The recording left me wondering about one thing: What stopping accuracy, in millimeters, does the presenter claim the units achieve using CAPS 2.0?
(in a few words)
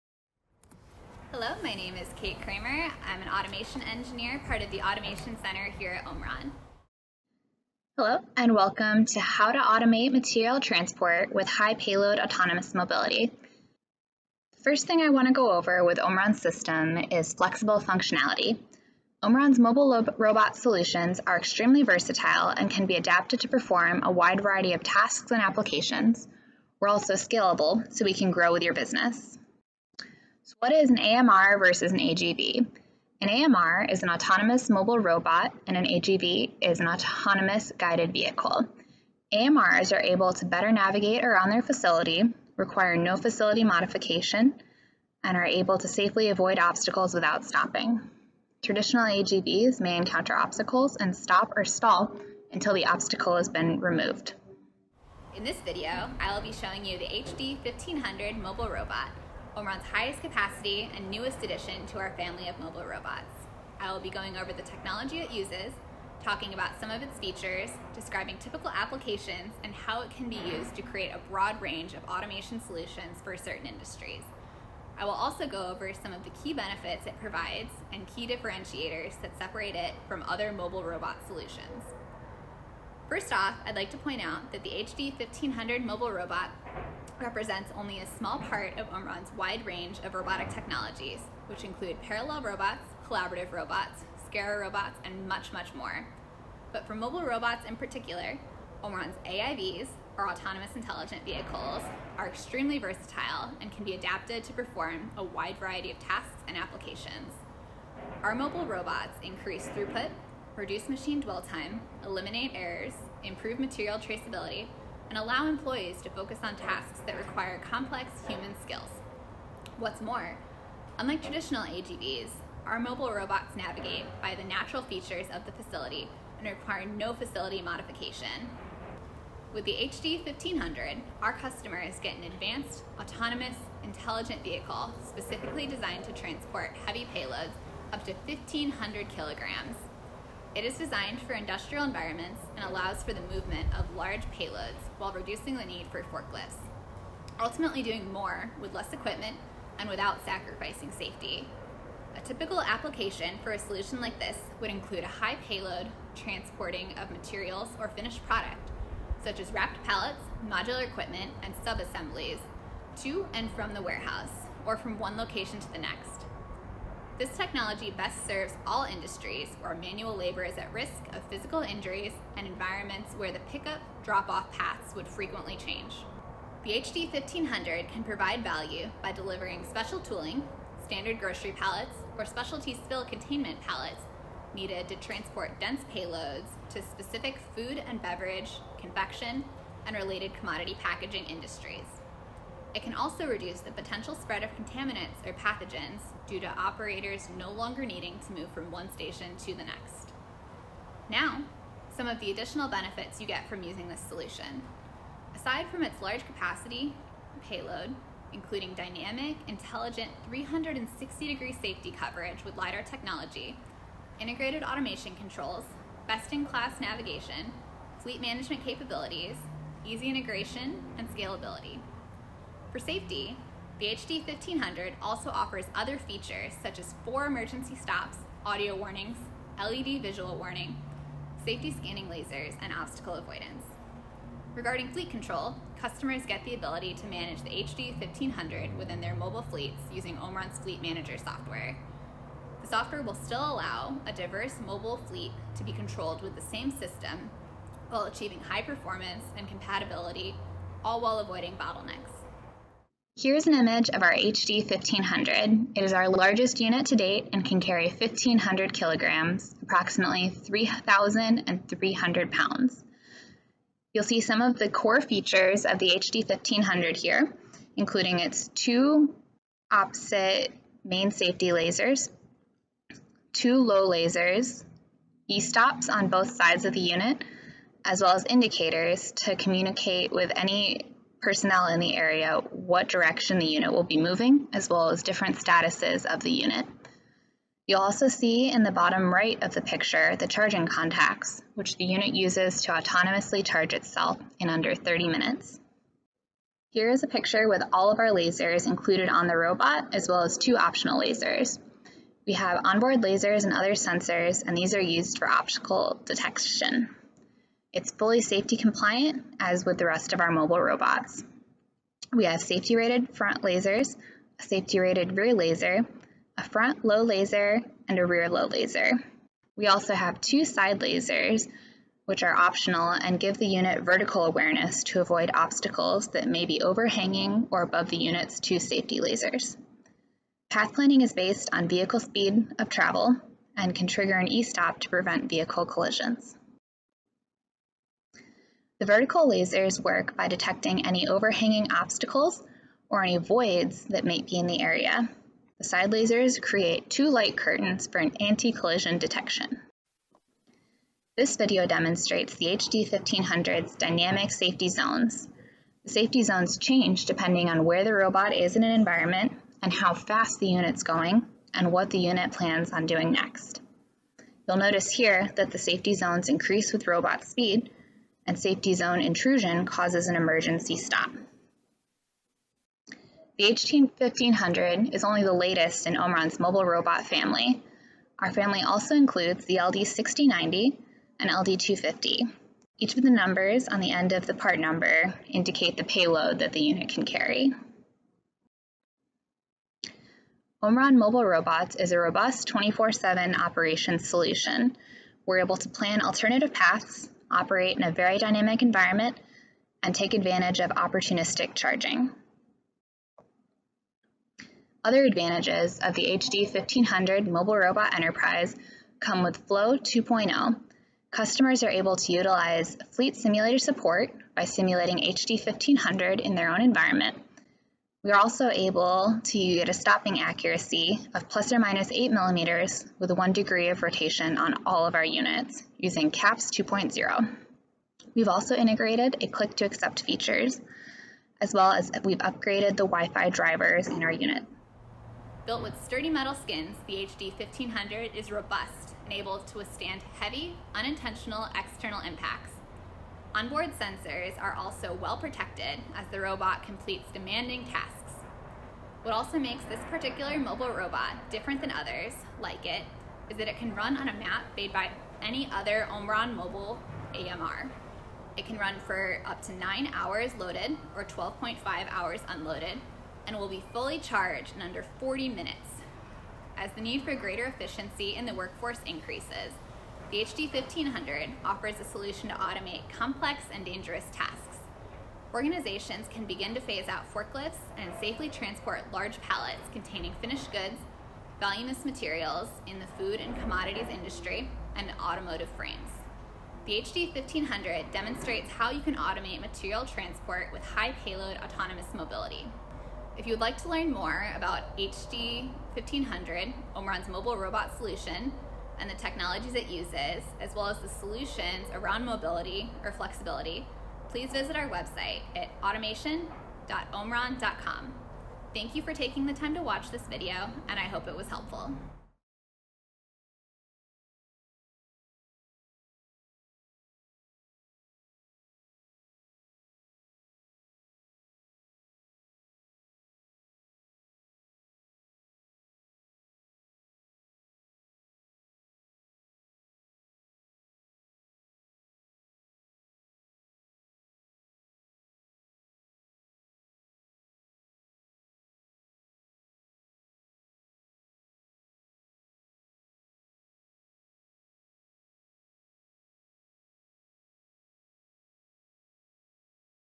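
plus or minus 8 millimeters.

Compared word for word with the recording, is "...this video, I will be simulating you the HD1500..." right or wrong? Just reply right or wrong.
wrong.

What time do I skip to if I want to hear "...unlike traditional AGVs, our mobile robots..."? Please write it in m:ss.
2:00.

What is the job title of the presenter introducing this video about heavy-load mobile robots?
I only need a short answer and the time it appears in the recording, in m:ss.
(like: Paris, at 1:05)
Automation engineer, at 0:03.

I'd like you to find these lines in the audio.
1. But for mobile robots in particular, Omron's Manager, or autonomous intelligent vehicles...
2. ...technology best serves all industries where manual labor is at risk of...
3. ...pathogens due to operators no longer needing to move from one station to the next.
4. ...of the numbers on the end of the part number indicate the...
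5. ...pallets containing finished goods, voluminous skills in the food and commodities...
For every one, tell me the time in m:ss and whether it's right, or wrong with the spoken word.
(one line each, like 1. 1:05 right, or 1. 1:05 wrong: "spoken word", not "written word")
1. 1:36 wrong: "AIVs", not "Manager"
2. 2:47 right
3. 3:15 right
4. 6:22 right
5. 7:59 wrong: "materials", not "skills".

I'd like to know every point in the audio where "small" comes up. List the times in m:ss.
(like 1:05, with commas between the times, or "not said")
1:28.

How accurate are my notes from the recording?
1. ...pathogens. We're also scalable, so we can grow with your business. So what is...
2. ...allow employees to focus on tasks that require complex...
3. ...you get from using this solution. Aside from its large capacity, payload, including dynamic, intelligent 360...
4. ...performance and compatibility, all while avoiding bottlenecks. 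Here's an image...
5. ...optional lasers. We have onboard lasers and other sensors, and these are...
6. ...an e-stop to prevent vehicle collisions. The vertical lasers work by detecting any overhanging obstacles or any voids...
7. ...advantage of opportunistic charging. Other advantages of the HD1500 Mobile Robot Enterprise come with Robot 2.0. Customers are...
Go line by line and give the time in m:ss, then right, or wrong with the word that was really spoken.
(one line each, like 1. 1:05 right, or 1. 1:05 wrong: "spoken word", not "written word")
1. 0:25 wrong: "applications", not "pathogens"
2. 1:55 right
3. 3:23 right
4. 4:08 right
5. 5:00 right
6. 5:34 right
7. 6:40 wrong: "Flow", not "Robot".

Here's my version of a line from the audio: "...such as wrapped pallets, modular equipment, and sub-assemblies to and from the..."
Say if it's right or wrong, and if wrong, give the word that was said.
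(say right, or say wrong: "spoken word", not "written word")
right.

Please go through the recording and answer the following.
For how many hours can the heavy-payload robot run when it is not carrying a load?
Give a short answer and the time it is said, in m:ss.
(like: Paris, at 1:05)
12.5 hours, at 7:41.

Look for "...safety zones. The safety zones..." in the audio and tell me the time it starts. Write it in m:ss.
5:54.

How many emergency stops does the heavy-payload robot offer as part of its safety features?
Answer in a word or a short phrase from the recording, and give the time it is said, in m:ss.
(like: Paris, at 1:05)
4, at 3:47.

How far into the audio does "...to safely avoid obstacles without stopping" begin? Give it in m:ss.
0:45.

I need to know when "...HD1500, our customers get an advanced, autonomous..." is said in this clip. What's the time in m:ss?
2:09.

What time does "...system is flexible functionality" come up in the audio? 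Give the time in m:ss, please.
0:16.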